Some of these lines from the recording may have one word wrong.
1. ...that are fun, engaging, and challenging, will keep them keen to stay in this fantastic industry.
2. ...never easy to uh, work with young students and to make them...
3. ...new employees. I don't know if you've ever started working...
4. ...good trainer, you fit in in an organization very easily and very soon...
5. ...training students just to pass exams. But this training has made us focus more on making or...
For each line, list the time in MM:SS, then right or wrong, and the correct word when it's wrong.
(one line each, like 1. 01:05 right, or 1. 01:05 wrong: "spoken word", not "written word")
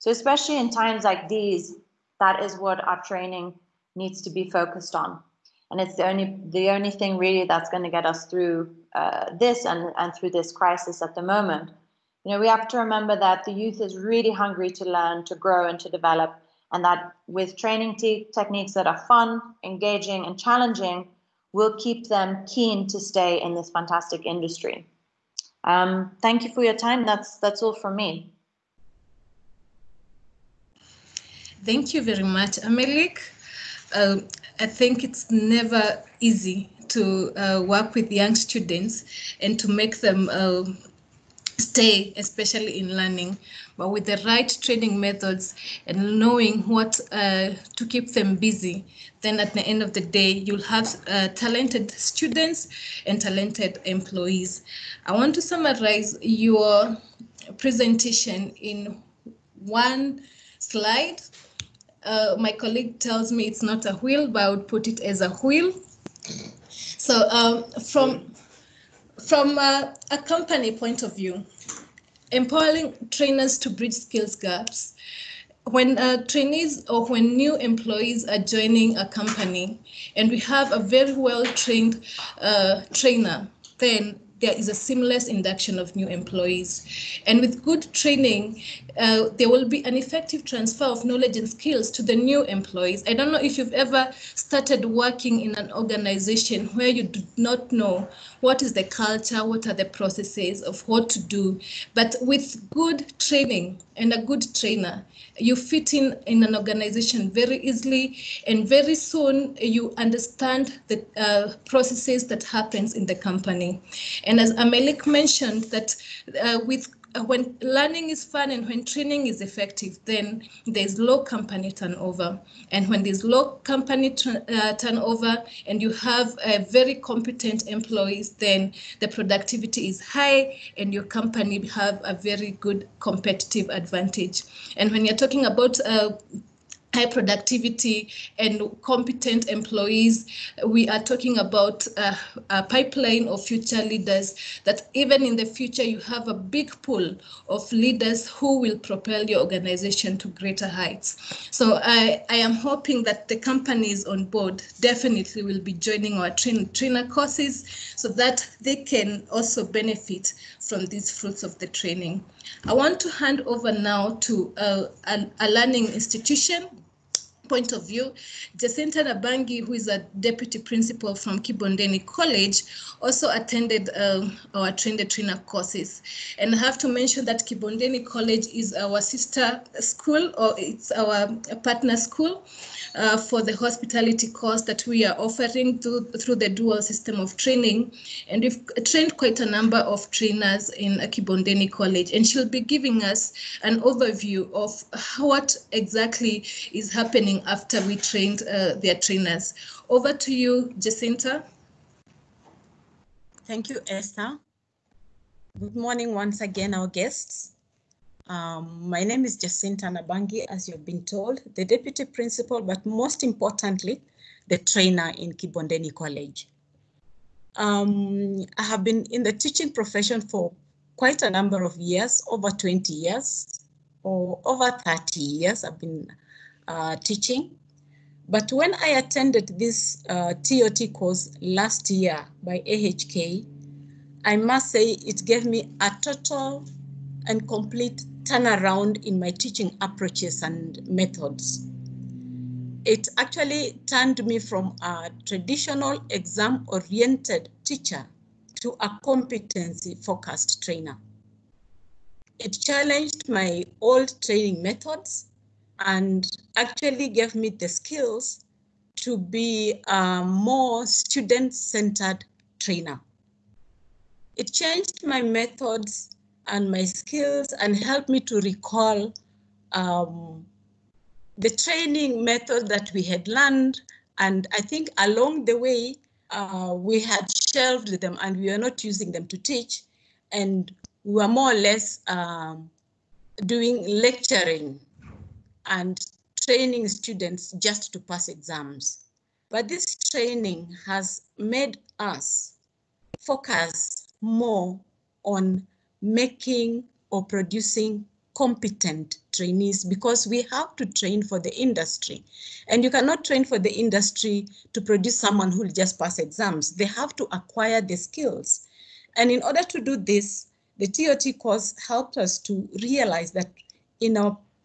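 1. 00:18 right
2. 00:35 right
3. 01:32 right
4. 01:44 right
5. 04:46 right.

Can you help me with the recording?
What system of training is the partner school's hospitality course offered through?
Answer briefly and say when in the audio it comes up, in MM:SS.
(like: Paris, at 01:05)
dual system, at 03:06.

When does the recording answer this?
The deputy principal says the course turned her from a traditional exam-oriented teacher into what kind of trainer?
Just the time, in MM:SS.
04:09.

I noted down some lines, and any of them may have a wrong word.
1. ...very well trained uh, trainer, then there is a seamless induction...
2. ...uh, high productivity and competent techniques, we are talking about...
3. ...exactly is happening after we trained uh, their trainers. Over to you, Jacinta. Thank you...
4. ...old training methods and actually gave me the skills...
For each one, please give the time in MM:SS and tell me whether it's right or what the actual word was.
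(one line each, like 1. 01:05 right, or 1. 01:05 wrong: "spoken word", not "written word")
1. 01:20 right
2. 02:15 wrong: "employees", not "techniques"
3. 03:15 right
4. 04:13 right.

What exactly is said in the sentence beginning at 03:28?
Um, my name is Jacinta Nabangi, as you've been told, the deputy principal, but most importantly, the trainer in Kibondeni College.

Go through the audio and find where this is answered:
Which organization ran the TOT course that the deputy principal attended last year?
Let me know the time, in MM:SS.
03:52.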